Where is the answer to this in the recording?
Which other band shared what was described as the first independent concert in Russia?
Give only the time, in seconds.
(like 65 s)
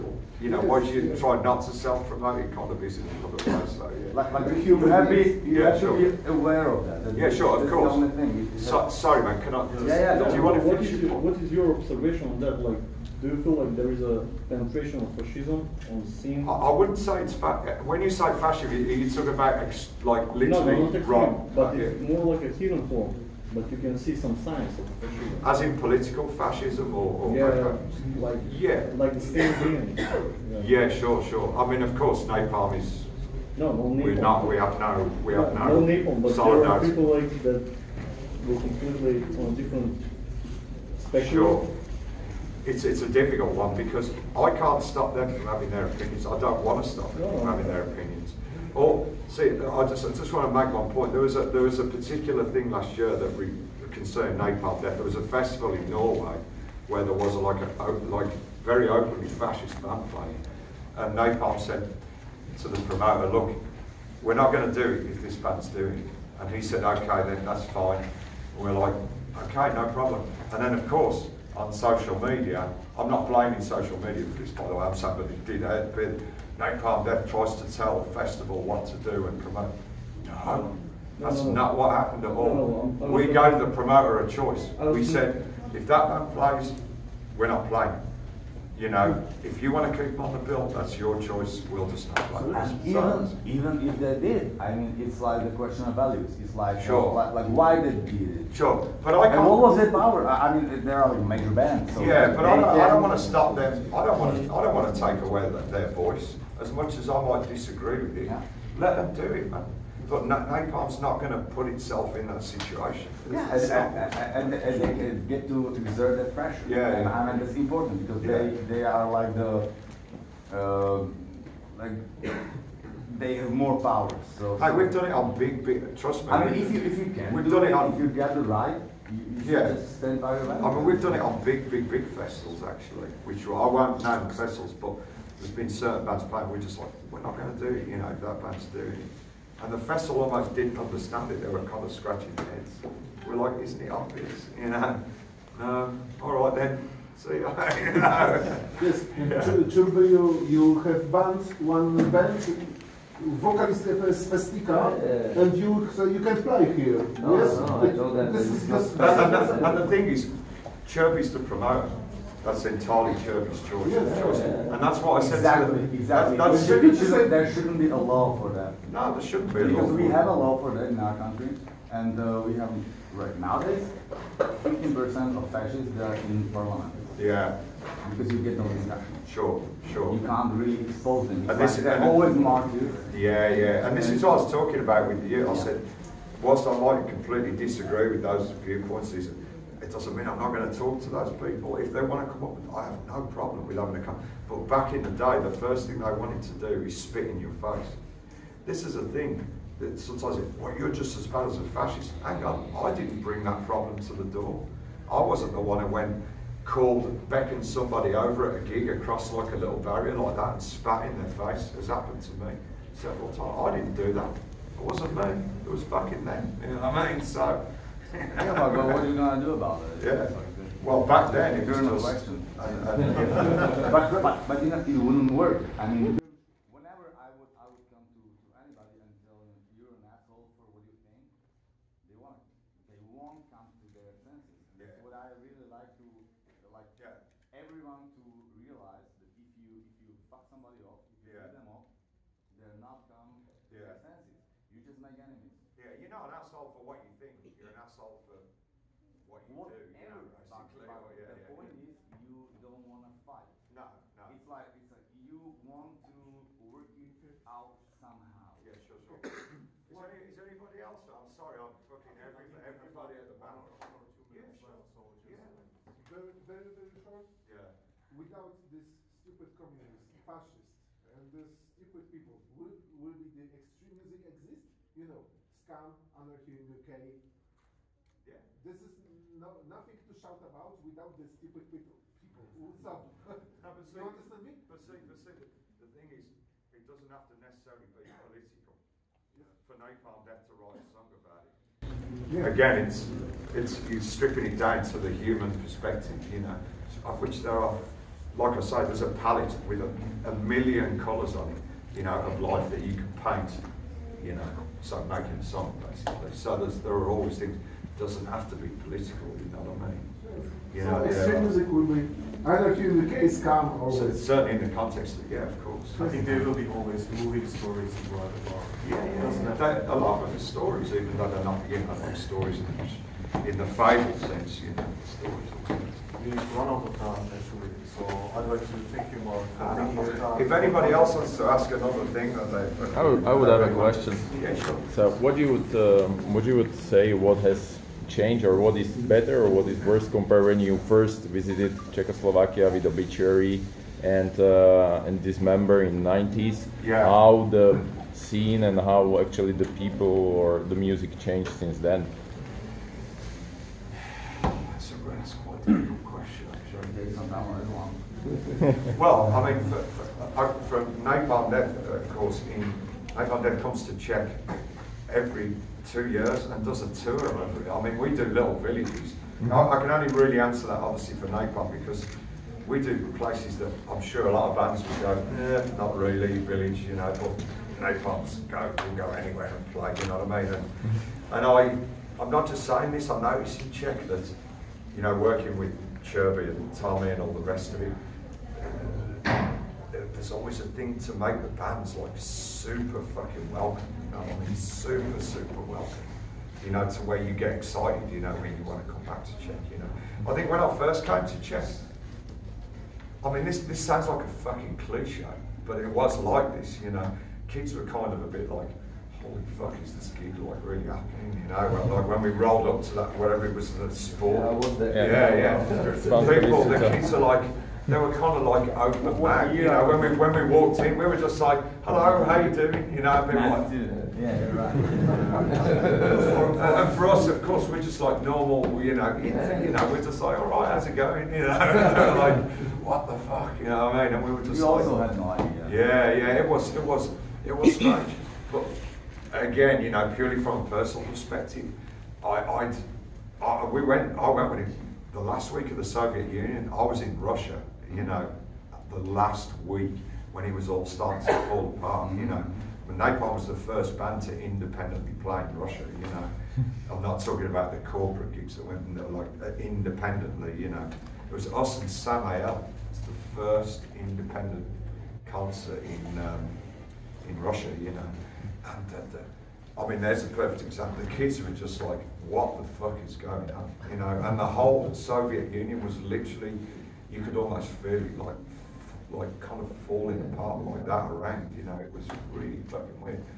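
461 s.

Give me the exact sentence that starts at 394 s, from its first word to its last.
I oh, he's super, super welcome.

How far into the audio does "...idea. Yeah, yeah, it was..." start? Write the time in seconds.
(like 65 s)
435 s.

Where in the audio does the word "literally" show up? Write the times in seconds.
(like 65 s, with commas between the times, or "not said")
20 s, 476 s.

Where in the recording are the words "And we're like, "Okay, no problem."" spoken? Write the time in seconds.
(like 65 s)
68 s.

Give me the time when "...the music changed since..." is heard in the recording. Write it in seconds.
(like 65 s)
350 s.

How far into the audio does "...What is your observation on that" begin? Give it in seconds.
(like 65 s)
11 s.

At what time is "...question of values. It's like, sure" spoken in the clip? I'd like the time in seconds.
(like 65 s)
95 s.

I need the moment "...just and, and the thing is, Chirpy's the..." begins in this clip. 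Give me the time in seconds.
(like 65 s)
158 s.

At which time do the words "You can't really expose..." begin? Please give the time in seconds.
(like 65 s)
180 s.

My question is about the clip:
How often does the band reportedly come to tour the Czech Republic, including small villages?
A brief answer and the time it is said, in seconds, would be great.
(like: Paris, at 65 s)
Every 2 years, at 365 s.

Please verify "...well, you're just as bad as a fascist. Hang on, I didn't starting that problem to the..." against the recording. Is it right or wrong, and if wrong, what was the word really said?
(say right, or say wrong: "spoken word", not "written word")
wrong: "bring", not "starting".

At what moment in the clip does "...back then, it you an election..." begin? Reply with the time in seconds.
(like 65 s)
221 s.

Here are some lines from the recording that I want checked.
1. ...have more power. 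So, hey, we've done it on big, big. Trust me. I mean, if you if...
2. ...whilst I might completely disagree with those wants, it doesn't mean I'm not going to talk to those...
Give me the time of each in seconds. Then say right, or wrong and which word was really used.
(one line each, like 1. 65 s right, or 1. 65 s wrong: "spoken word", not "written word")
1. 123 s right
2. 186 s wrong: "viewpoints", not "wants".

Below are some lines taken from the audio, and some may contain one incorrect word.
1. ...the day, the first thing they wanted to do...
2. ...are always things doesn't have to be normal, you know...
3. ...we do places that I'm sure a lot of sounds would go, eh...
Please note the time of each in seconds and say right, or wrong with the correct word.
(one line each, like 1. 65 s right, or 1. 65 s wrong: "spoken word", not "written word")
1. 195 s right
2. 306 s wrong: "political", not "normal"
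3. 372 s wrong: "bands", not "sounds".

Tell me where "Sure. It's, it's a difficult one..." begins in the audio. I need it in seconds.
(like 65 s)
41 s.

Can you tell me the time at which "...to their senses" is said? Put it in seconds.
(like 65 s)
233 s.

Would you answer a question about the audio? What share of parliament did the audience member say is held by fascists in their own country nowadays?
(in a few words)
15%.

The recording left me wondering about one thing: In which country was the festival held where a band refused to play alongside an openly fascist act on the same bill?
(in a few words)
Norway.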